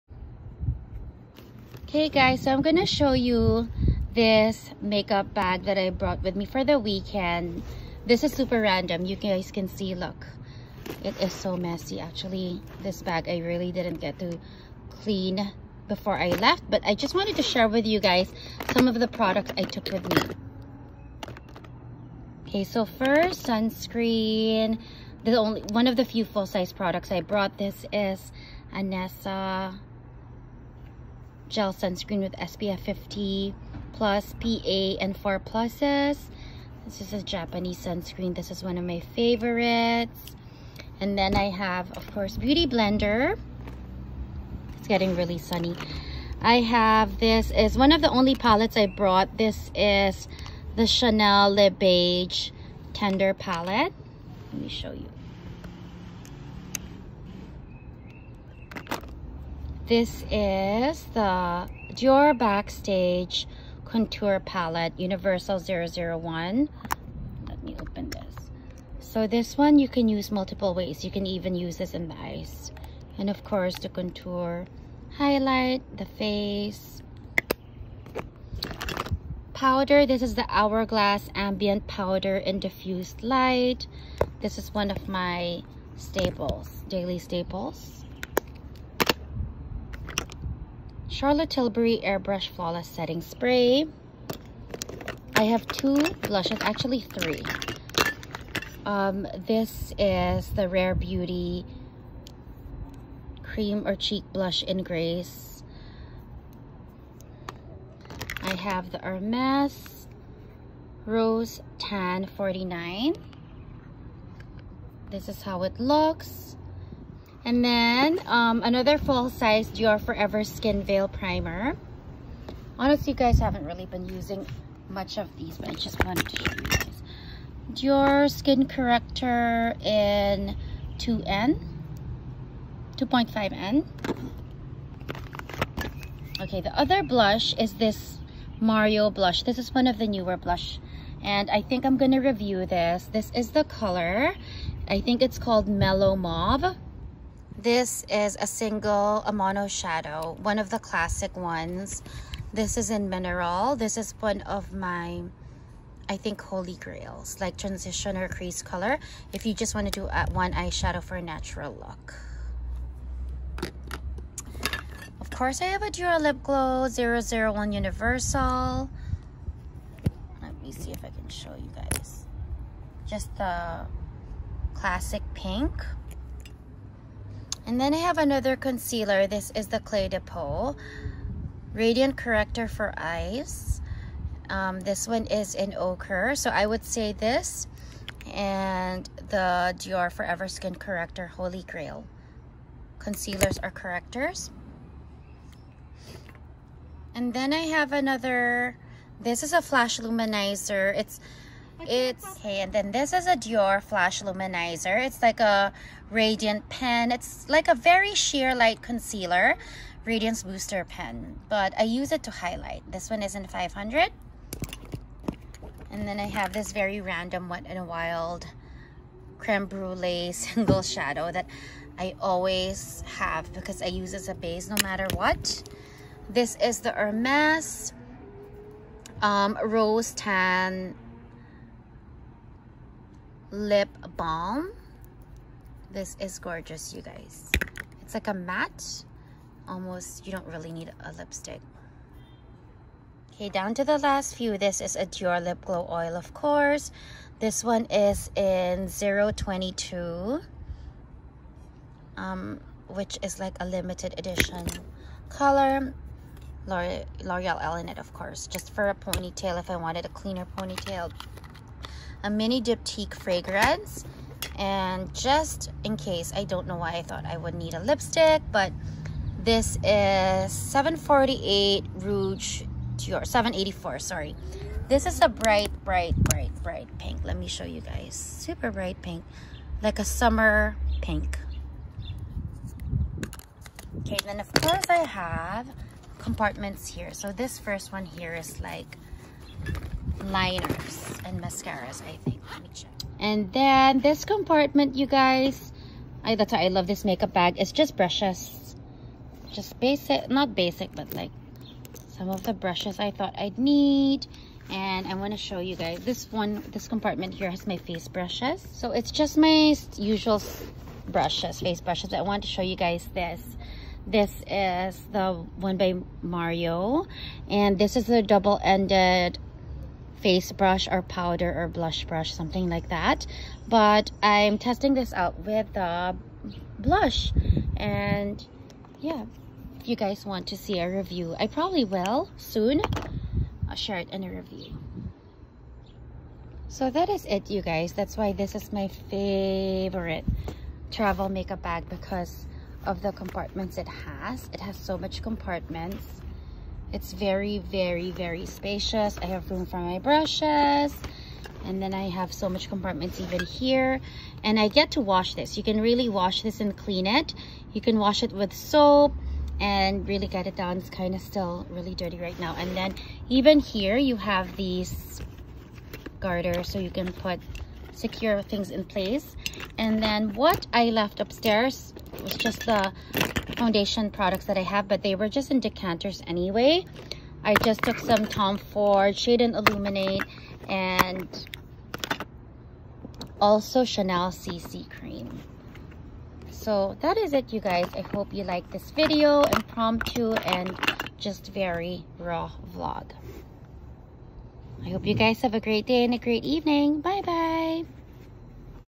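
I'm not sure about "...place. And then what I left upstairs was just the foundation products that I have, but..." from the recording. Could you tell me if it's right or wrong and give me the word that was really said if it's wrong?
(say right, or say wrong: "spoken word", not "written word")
right.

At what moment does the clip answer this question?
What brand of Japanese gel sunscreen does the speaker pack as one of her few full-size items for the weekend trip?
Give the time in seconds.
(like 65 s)
28 s.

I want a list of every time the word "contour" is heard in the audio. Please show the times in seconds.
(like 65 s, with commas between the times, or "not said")
63 s, 73 s.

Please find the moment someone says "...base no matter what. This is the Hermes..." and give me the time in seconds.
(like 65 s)
224 s.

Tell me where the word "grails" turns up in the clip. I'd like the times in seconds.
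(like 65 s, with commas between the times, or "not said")
156 s, 191 s.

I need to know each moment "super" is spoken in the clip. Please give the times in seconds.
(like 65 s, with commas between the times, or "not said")
8 s, 278 s.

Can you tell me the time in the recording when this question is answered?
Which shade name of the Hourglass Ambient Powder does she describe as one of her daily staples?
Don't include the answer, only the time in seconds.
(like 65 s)
82 s.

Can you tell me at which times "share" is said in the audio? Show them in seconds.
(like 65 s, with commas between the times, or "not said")
17 s, 333 s.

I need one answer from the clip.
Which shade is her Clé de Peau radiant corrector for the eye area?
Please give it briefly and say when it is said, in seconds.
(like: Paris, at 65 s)
Ochre, at 185 s.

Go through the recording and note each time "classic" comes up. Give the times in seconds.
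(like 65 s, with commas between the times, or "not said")
150 s, 174 s.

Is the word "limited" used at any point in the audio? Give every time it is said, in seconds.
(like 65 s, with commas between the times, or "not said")
253 s.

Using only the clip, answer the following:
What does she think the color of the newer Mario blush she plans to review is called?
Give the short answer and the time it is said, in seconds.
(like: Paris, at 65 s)
Mellow Mauve, at 145 s.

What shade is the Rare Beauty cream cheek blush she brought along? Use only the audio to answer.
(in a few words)
Grace.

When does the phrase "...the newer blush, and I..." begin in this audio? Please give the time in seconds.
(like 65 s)
139 s.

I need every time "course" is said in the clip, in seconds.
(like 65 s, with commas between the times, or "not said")
42 s, 73 s, 165 s, 246 s, 258 s, 284 s.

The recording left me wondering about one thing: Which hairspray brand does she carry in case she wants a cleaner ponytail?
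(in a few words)
L'Oreal Elnett.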